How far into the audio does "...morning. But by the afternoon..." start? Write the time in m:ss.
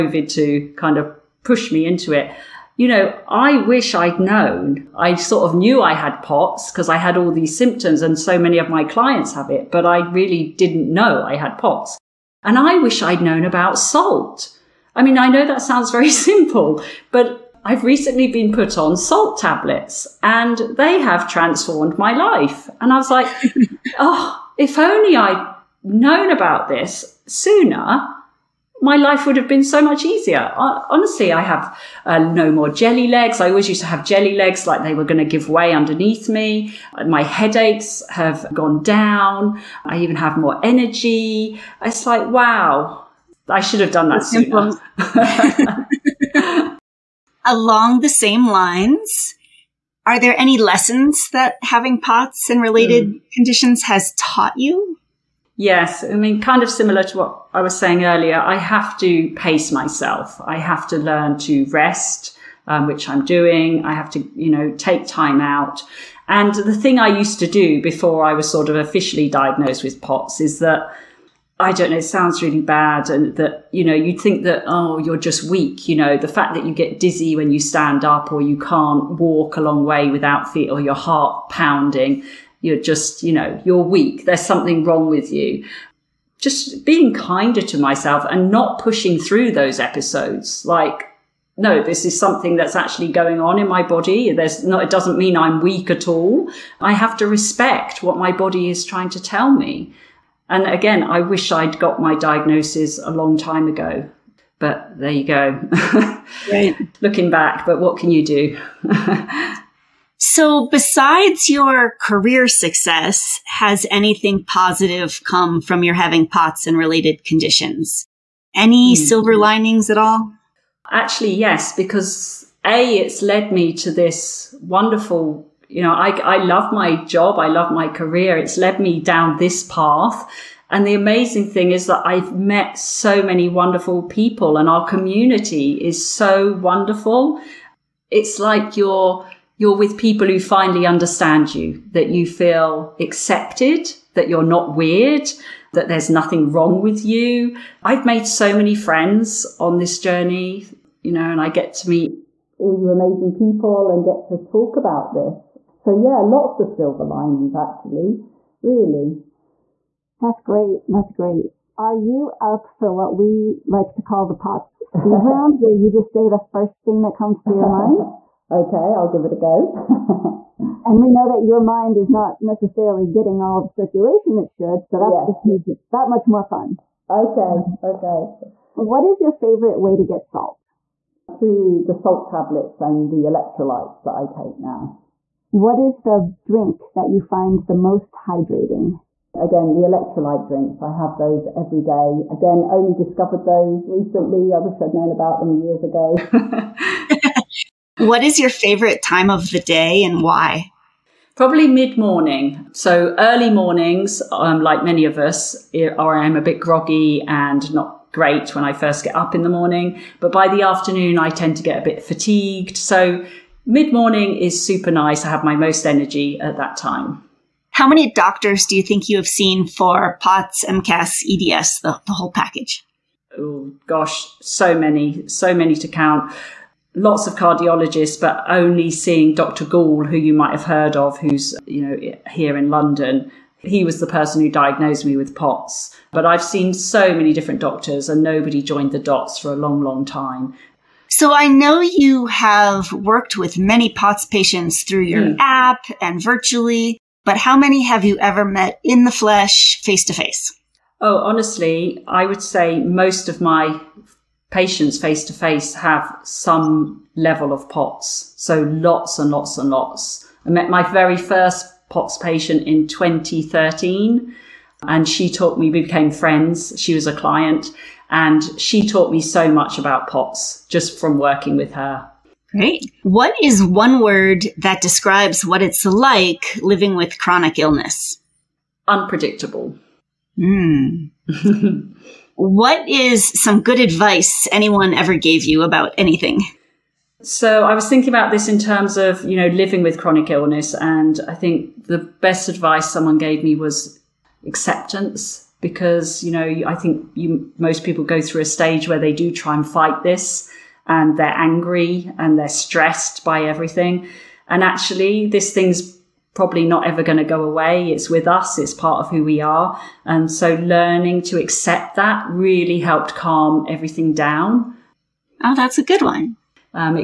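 3:29.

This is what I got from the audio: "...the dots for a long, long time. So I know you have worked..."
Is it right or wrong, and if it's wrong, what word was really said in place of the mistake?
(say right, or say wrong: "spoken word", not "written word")
right.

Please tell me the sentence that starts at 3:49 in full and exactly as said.
Gall, who you might have heard of, who's, you know, here in London.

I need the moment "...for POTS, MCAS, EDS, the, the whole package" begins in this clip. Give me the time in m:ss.
3:39.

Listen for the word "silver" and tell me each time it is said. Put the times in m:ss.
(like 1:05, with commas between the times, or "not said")
1:59, 2:36.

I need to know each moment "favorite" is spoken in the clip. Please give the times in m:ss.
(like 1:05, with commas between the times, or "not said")
2:59, 3:18.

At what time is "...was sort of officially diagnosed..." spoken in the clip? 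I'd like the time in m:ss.
1:08.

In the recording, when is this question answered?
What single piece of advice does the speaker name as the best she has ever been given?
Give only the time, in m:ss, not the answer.
4:54.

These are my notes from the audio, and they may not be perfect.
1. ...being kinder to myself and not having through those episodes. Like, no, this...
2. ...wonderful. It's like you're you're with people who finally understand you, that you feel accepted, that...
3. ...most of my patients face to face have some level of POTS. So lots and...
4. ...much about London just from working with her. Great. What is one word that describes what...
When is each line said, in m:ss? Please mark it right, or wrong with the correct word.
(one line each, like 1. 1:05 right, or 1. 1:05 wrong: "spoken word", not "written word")
1. 1:26 wrong: "pushing", not "having"
2. 2:16 right
3. 4:12 right
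4. 4:29 wrong: "POTS", not "London".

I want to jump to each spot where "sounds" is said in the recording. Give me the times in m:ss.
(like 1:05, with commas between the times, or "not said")
0:15, 1:12.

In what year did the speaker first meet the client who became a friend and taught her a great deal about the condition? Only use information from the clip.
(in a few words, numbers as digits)
2013.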